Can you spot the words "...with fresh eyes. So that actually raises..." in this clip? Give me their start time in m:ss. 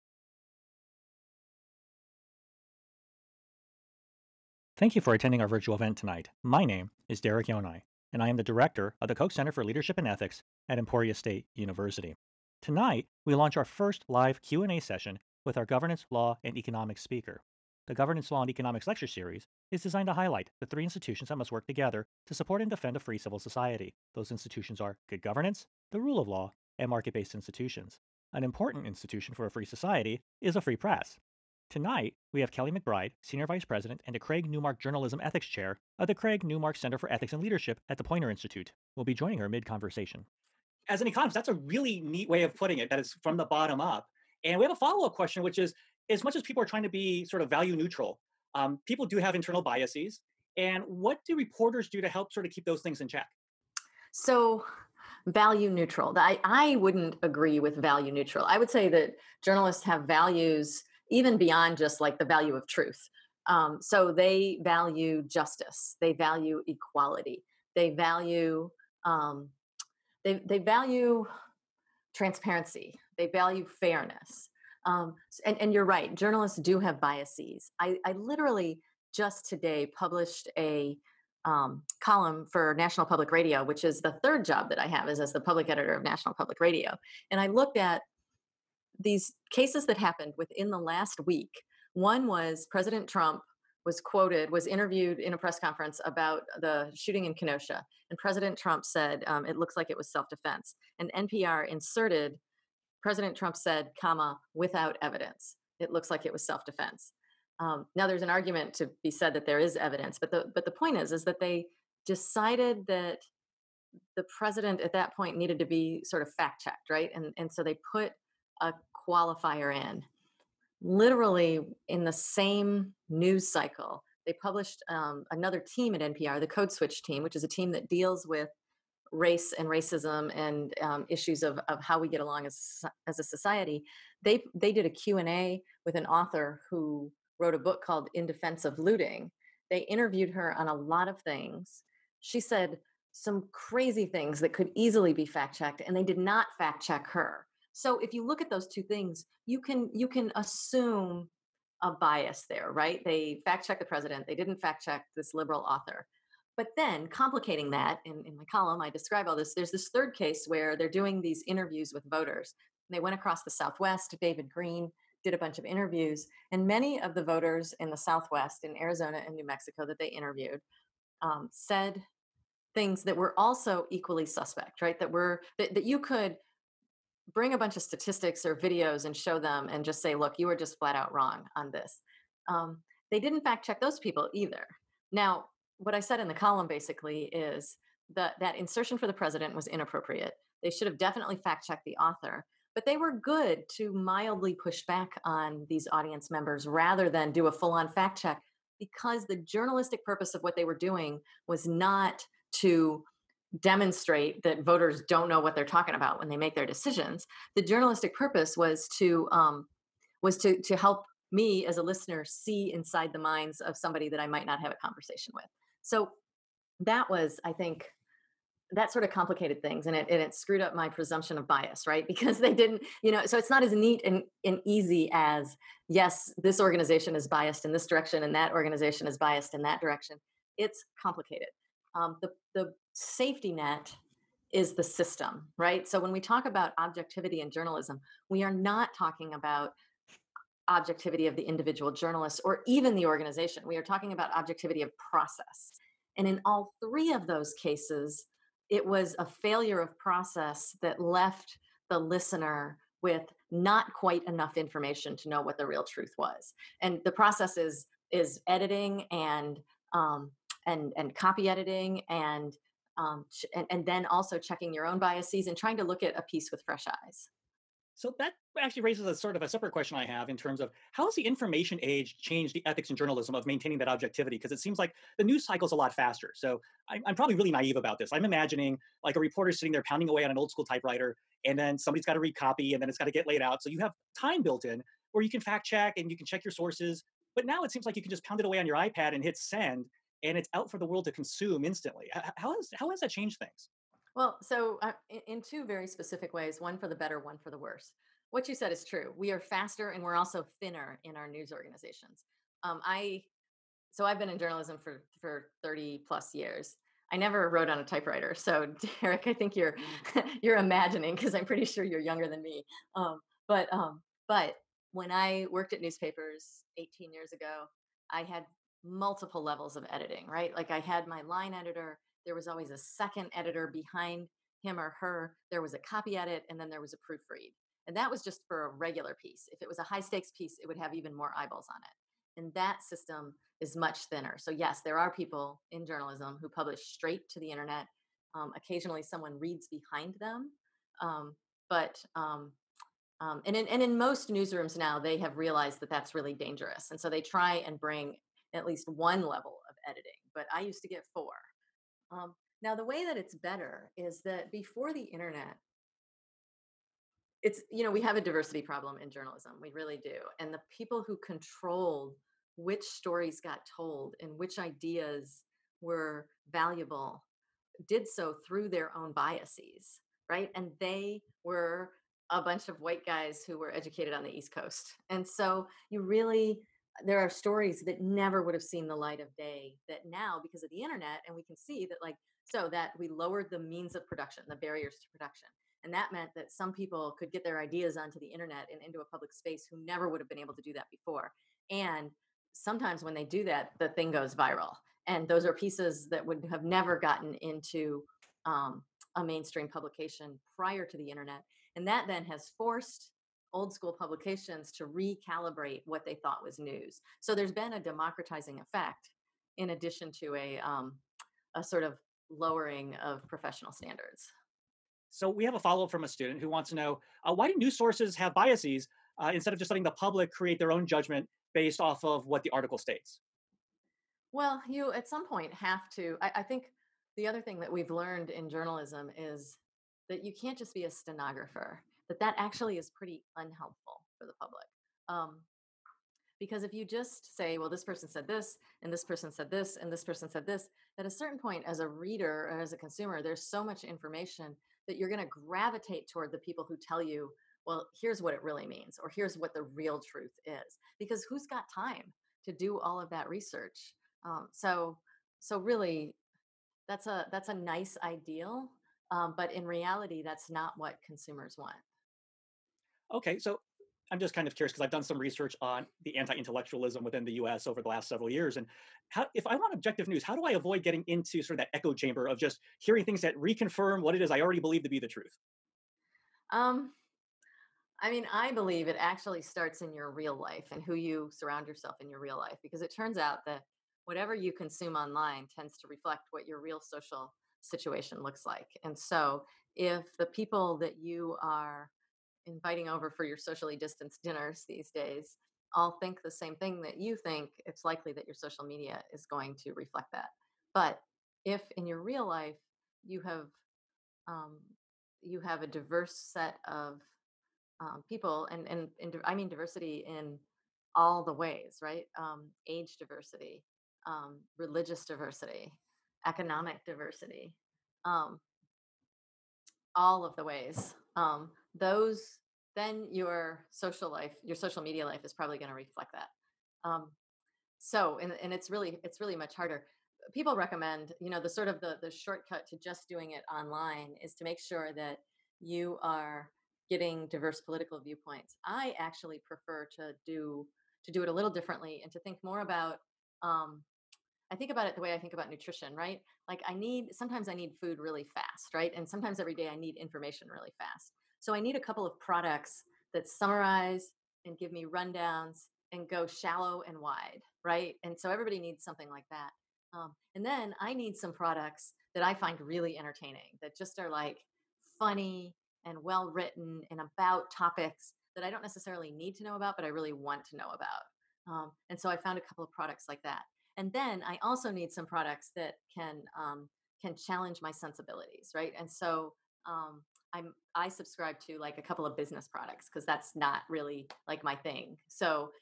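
4:26.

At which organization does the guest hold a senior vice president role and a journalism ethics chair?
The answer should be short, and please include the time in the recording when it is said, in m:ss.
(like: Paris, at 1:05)
Poynter Institute, at 0:38.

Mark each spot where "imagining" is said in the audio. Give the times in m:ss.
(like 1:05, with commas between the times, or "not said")
4:38, 5:10.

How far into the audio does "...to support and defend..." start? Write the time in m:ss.
0:22.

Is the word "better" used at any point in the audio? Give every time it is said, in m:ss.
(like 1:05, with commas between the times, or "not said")
4:56, 5:53.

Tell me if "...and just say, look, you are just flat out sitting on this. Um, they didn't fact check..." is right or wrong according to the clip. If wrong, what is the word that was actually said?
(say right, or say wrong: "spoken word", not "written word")
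wrong: "wrong", not "sitting".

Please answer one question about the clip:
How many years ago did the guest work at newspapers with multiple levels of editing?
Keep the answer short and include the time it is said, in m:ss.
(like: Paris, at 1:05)
18, at 5:16.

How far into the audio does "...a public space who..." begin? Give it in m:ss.
6:28.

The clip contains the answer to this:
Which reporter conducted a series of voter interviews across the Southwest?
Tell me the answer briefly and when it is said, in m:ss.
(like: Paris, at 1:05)
David Greene, at 2:44.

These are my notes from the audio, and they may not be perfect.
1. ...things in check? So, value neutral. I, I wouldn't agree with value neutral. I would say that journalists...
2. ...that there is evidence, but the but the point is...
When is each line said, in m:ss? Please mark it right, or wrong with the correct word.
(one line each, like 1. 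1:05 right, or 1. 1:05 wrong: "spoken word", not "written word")
1. 0:52 right
2. 1:49 right.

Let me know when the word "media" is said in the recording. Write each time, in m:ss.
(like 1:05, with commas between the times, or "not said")
8:18, 8:44.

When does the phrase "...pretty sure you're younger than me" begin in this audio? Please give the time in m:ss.
5:11.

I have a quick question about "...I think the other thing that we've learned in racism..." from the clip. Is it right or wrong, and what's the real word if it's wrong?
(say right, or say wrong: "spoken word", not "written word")
wrong: "journalism", not "racism".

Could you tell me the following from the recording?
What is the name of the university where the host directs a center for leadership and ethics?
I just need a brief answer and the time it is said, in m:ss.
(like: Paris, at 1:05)
Emporia State University, at 0:10.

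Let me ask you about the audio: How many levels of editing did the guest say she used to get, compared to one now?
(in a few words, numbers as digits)
4.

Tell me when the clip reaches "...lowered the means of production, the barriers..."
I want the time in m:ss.
6:23.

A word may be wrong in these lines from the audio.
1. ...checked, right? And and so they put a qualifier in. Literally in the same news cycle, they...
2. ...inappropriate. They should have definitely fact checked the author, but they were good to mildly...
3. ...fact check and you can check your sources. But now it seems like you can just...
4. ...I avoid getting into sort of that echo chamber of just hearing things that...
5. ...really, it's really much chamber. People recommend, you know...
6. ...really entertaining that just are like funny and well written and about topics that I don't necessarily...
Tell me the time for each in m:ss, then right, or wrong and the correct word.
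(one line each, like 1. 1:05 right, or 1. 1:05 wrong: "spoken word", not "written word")
1. 1:56 right
2. 3:09 right
3. 4:45 right
4. 7:50 right
5. 8:48 wrong: "harder", not "chamber"
6. 9:22 right.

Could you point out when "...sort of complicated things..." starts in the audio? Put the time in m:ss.
3:38.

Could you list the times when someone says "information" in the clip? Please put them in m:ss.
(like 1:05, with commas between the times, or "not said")
4:14, 4:31, 7:23, 9:09.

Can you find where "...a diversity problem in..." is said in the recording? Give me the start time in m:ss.
5:58.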